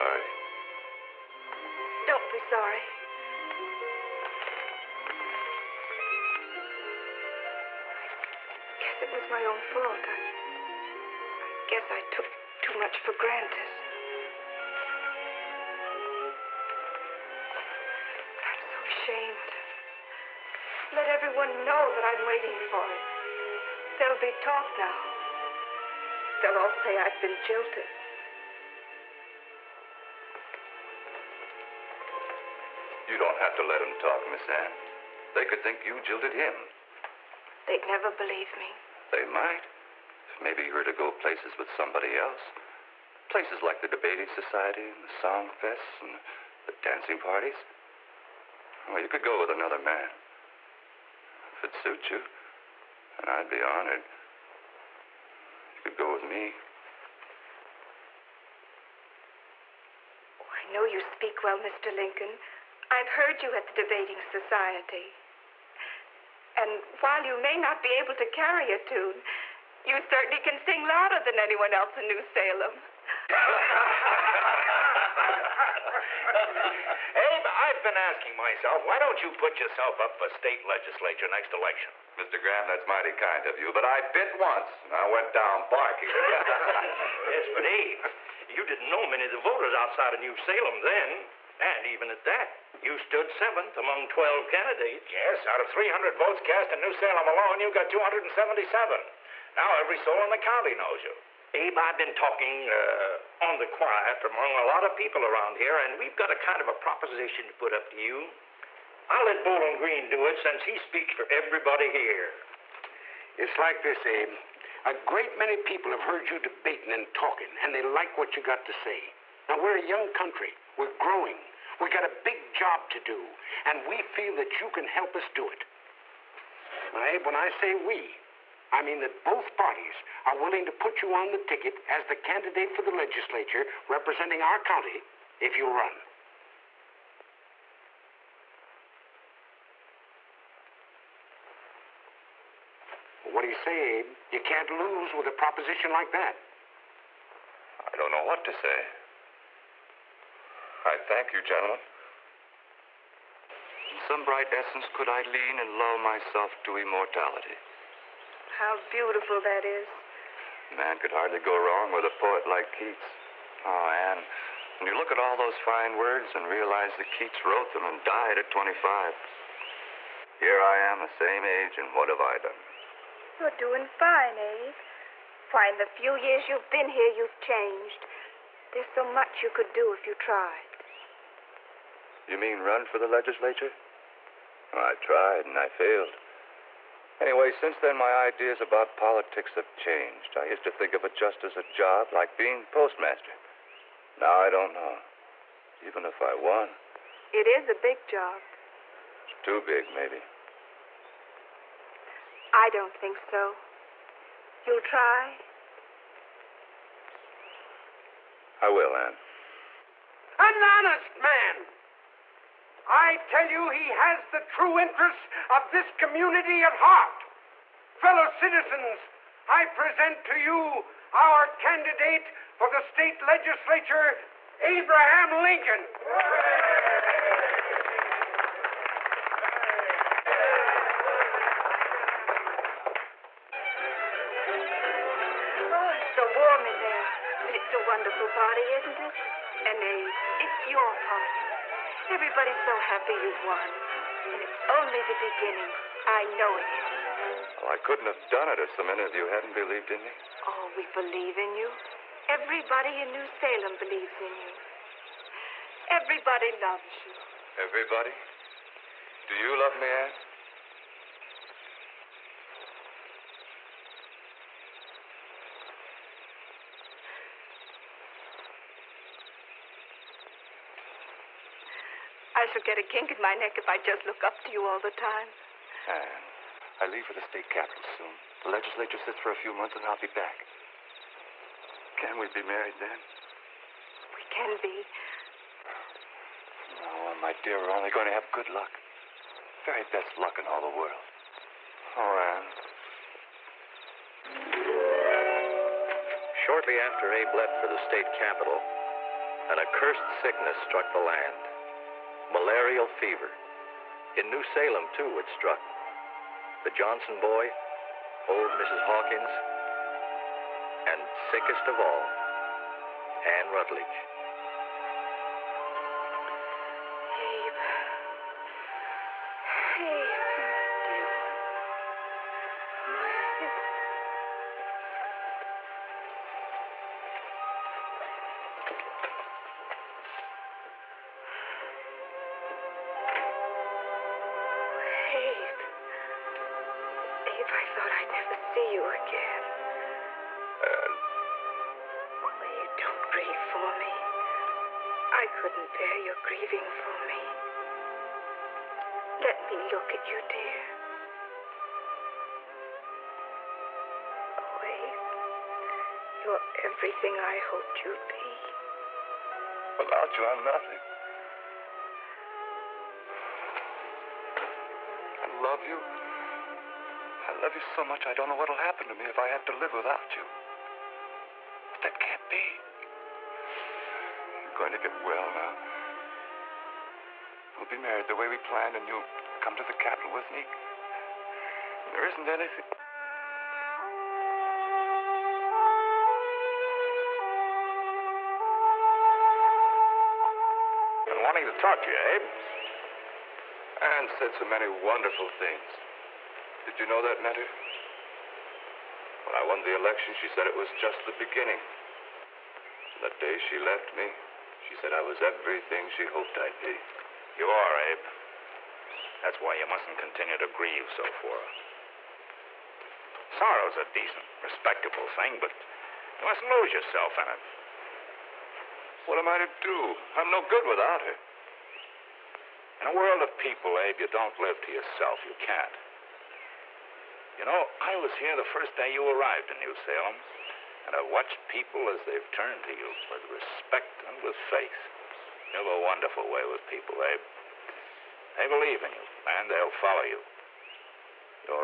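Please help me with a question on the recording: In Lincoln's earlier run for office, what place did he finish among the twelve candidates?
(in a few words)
Seventh.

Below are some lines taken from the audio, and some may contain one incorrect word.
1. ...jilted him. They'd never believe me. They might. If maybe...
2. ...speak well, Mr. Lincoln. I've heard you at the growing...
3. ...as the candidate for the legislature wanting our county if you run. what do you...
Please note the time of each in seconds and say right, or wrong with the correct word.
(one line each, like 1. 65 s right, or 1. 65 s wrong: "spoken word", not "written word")
1. 35 s right
2. 60 s wrong: "debating", not "growing"
3. 131 s wrong: "representing", not "wanting".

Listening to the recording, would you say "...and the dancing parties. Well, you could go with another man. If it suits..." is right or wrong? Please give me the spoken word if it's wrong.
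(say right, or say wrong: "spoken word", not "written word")
right.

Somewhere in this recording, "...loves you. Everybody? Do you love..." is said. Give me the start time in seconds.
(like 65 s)
256 s.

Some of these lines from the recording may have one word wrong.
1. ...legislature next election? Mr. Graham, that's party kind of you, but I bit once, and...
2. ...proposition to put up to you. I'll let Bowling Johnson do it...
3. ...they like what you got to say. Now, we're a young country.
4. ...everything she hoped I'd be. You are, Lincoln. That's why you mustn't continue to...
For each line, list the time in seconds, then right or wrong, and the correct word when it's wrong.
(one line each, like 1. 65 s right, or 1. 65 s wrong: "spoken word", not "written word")
1. 80 s wrong: "mighty", not "party"
2. 106 s wrong: "Green", not "Johnson"
3. 117 s right
4. 405 s wrong: "Abe", not "Lincoln".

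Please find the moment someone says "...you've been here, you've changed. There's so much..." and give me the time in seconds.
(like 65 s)
176 s.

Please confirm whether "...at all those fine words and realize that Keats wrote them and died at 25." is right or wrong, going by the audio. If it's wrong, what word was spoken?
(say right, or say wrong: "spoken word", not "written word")
right.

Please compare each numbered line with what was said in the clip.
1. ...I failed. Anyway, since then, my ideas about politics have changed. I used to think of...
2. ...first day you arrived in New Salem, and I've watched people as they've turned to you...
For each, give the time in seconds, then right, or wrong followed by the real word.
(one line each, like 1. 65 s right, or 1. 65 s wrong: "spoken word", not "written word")
1. 185 s right
2. 428 s right.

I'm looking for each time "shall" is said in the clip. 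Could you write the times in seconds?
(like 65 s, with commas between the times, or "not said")
272 s.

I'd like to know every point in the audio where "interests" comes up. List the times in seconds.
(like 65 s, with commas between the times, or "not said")
214 s.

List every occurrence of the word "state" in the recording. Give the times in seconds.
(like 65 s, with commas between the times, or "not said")
80 s, 222 s, 277 s, 297 s.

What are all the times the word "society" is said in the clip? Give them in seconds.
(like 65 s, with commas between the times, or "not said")
44 s, 64 s.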